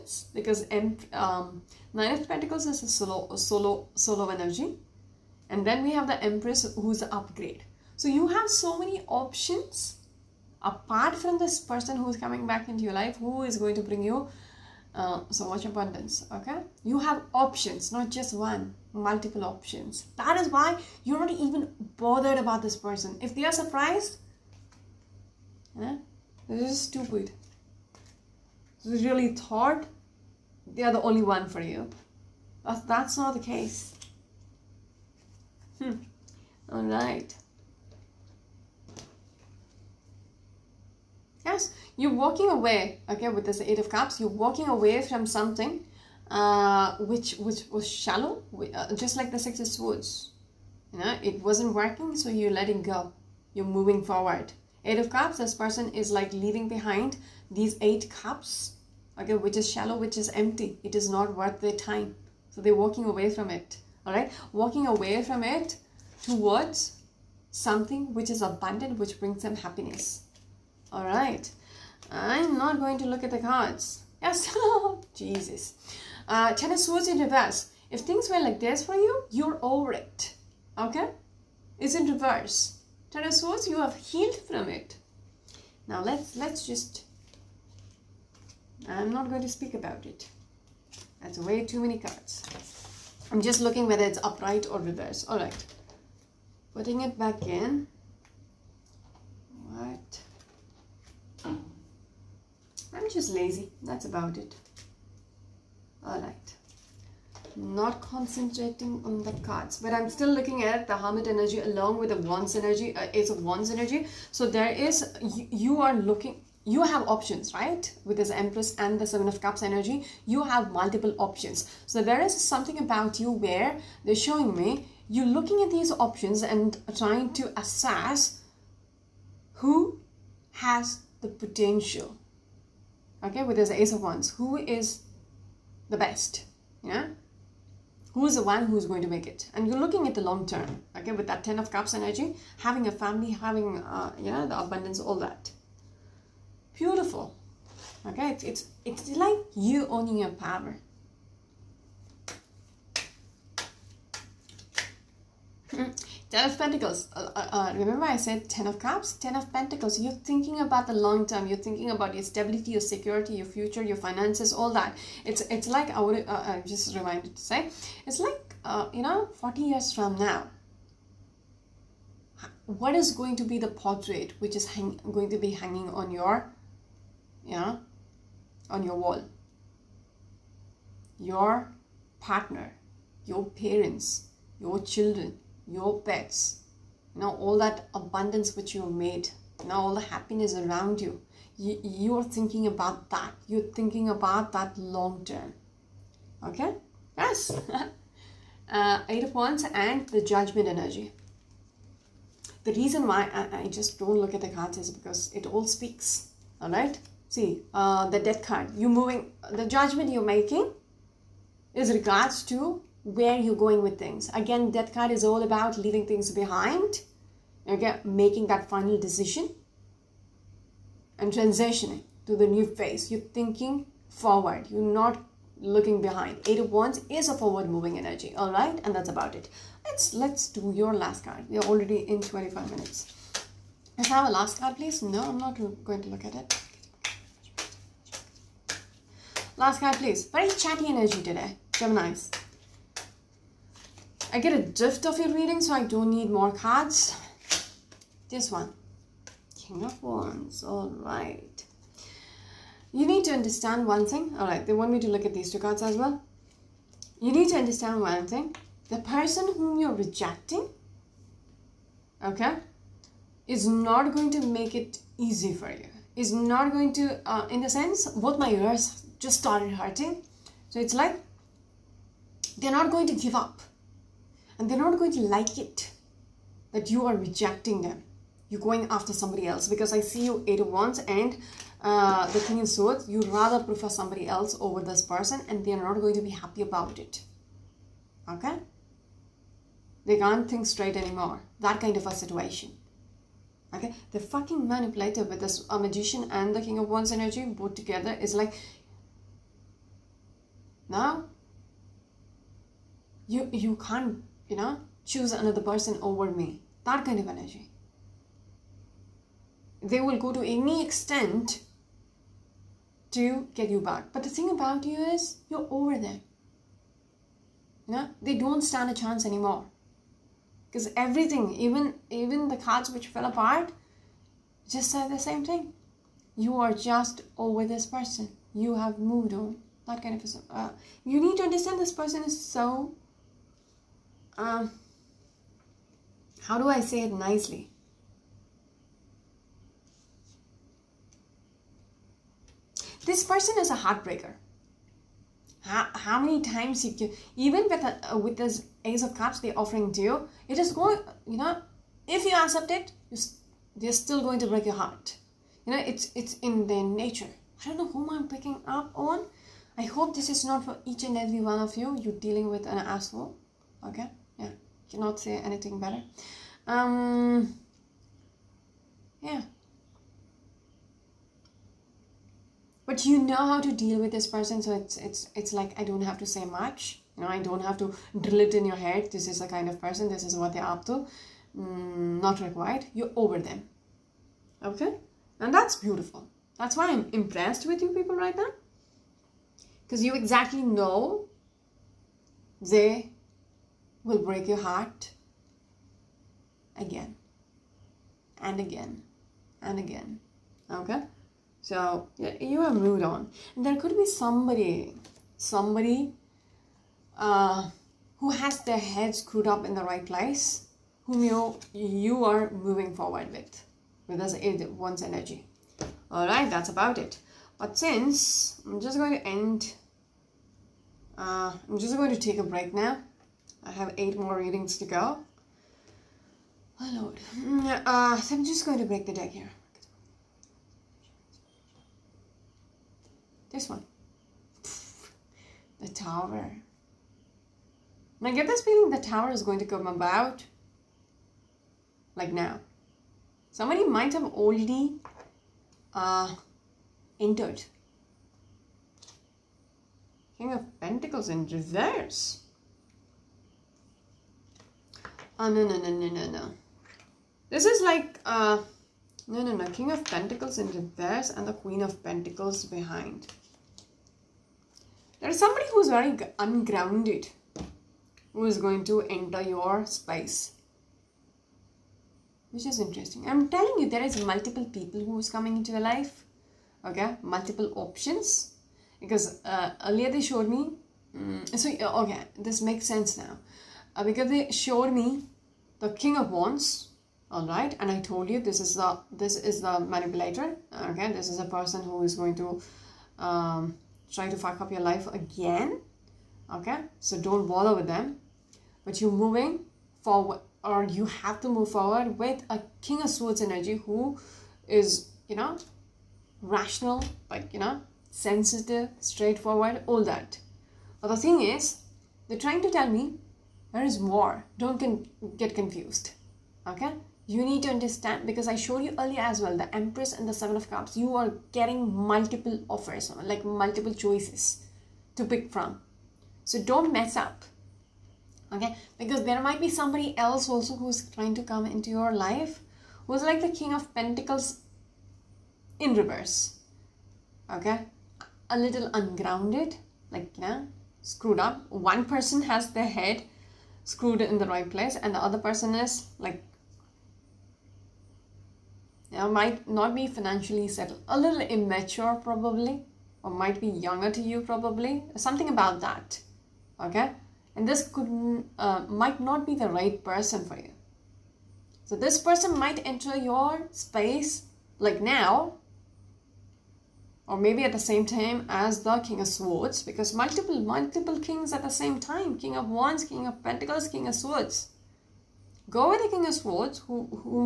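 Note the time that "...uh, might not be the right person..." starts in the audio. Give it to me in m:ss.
9:18.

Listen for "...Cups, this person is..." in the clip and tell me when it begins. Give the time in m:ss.
0:55.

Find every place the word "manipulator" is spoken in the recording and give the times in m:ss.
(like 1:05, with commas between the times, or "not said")
4:54, 8:09.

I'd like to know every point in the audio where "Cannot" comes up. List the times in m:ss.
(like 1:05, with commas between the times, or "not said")
6:04.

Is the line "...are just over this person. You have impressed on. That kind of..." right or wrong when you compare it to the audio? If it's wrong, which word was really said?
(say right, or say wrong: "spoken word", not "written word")
wrong: "moved", not "impressed".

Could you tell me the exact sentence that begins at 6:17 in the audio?
You know, I don't have to drill it in your head.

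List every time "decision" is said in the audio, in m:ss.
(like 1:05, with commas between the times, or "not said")
3:39.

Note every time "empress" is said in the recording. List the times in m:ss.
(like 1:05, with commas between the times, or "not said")
0:06, 1:58, 8:39.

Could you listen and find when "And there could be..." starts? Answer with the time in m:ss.
6:43.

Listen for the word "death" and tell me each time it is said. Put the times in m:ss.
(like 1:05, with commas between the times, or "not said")
3:28, 3:34.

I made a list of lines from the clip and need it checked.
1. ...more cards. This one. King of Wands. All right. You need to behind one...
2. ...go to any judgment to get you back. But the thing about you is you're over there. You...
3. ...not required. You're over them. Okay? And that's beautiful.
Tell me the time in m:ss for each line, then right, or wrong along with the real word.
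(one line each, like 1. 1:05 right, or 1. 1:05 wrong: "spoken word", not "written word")
1. 4:06 wrong: "understand", not "behind"
2. 5:10 wrong: "extent", not "judgment"
3. 6:22 right.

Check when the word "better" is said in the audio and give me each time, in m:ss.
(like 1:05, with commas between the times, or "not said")
6:05.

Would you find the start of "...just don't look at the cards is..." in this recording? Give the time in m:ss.
3:23.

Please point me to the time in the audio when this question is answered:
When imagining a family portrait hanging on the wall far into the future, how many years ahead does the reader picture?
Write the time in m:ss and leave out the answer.
2:49.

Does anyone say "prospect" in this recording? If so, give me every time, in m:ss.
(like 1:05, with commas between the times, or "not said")
not said.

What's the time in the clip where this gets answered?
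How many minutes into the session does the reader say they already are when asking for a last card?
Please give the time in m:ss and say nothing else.
3:52.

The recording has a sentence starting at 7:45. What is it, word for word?
There is somebody who is very ungrounded who is going to enter your space.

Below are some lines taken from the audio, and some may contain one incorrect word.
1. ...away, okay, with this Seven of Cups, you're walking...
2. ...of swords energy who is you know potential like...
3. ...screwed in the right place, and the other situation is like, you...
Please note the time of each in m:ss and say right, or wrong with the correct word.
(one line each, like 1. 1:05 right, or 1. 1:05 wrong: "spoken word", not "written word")
1. 0:42 wrong: "Eight", not "Seven"
2. 8:23 wrong: "rational", not "potential"
3. 9:03 wrong: "person", not "situation".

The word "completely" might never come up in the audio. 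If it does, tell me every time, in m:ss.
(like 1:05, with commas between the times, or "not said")
not said.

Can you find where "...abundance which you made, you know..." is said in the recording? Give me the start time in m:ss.
3:07.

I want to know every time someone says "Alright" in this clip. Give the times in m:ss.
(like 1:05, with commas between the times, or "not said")
1:35, 1:46.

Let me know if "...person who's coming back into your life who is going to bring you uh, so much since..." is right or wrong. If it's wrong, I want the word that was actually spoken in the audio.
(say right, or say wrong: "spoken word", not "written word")
wrong: "abundance", not "since".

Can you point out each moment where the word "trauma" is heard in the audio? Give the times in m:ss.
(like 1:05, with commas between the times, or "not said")
not said.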